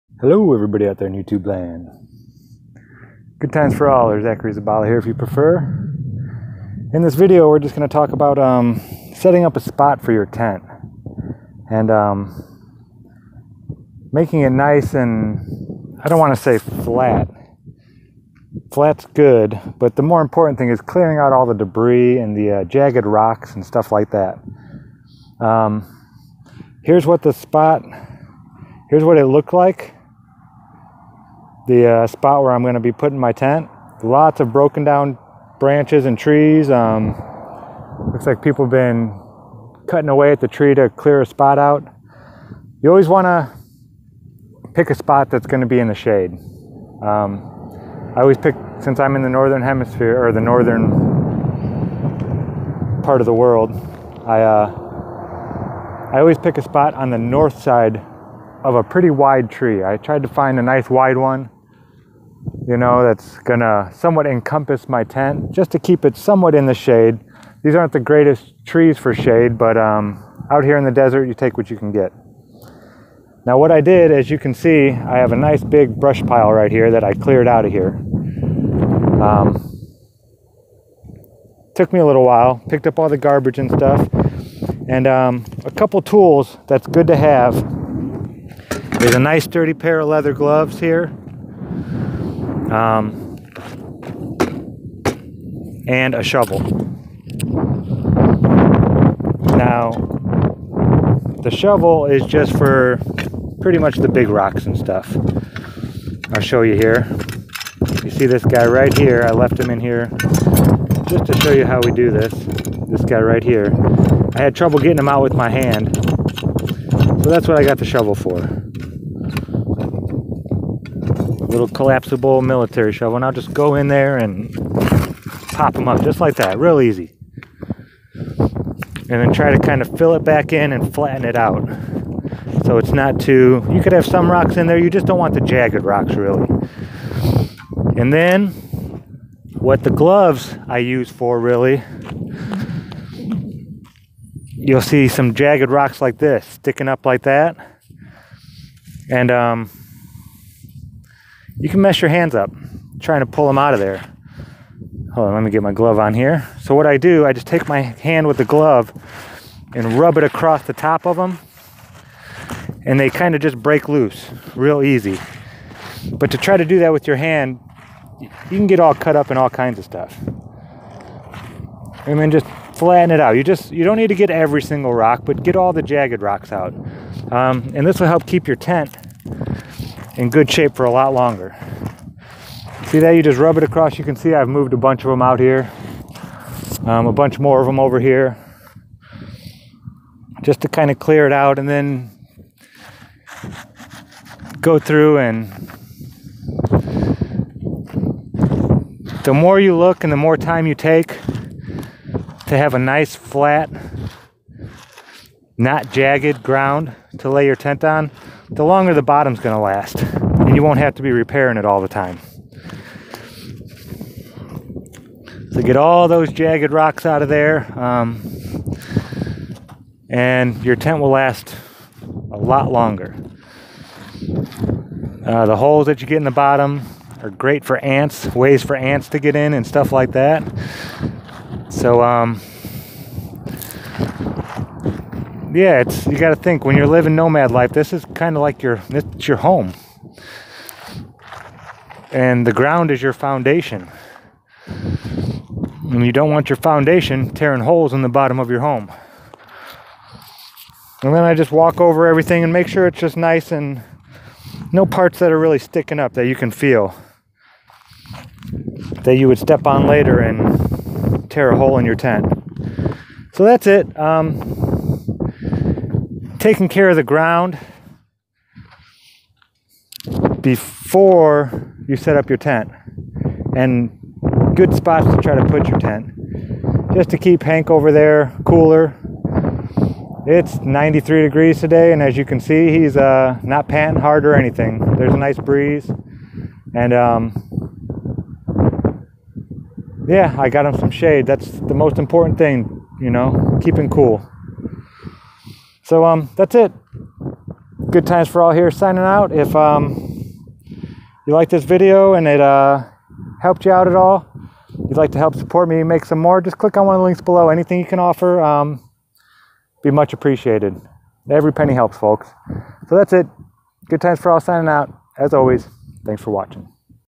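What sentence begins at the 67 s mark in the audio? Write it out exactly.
These aren't the greatest trees for shade, but um, out here in the desert, you take what you can get.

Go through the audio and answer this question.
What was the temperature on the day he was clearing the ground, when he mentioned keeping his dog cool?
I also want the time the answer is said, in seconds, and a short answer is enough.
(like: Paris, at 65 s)
93 degrees, at 280 s.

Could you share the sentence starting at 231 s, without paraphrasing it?
So, um, yeah, it's you got to think when you're living nomad life.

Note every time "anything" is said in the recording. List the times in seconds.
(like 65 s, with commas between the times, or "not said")
284 s, 307 s.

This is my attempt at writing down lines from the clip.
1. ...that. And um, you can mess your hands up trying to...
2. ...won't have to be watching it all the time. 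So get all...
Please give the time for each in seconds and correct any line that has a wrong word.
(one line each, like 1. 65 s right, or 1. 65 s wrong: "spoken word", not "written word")
1. 147 s right
2. 210 s wrong: "repairing", not "watching".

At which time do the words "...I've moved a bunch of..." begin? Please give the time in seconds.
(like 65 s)
184 s.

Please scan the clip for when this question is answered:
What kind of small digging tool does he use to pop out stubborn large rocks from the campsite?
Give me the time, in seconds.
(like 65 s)
121 s.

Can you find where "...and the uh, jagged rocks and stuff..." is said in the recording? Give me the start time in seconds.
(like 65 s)
22 s.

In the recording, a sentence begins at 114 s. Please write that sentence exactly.
I had trouble getting him out with my hand.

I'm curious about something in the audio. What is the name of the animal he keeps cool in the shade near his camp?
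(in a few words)
Hank.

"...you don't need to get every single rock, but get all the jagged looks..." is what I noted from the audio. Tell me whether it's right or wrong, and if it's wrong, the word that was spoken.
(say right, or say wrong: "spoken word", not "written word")
wrong: "rocks", not "looks".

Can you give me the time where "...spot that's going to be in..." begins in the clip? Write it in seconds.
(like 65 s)
44 s.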